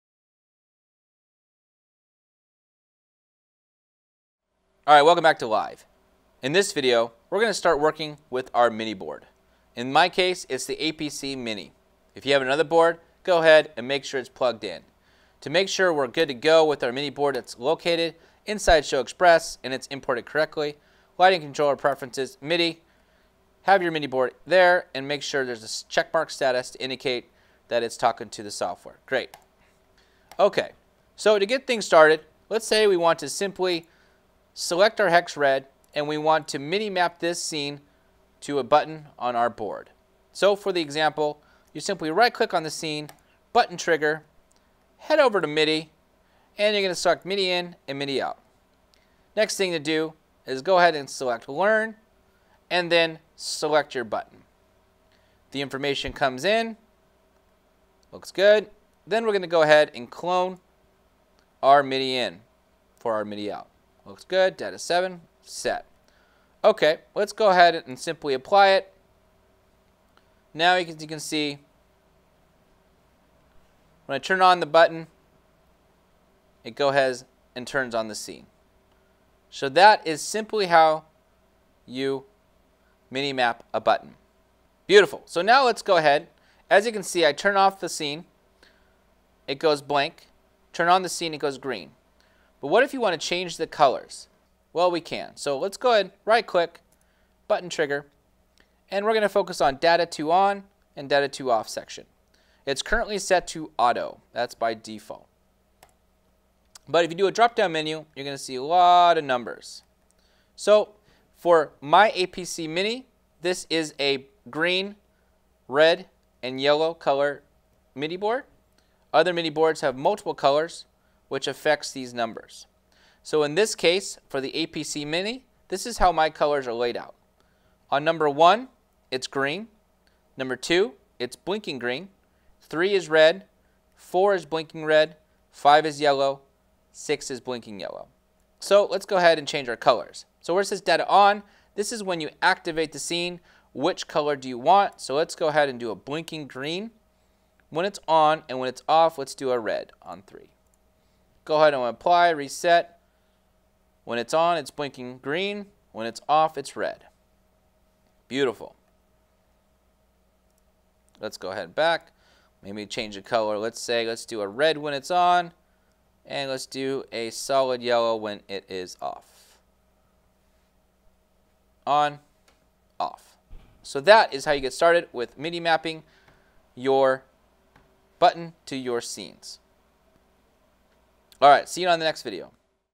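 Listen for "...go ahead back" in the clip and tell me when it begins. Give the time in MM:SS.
02:41.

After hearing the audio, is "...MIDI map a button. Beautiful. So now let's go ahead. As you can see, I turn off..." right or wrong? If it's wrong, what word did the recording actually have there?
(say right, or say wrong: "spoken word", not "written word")
right.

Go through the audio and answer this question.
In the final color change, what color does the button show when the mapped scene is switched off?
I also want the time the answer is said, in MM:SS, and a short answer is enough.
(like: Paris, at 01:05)
solid yellow, at 02:47.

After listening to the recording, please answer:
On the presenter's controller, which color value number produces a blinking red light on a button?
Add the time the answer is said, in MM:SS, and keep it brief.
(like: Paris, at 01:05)
4, at 02:13.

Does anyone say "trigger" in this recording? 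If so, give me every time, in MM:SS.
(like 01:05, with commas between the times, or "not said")
00:43, 01:37.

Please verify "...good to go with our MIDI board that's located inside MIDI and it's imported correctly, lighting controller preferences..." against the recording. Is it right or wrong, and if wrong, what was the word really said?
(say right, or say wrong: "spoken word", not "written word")
wrong: "ShowXpress", not "MIDI".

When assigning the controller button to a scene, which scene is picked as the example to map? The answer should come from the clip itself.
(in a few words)
hex red.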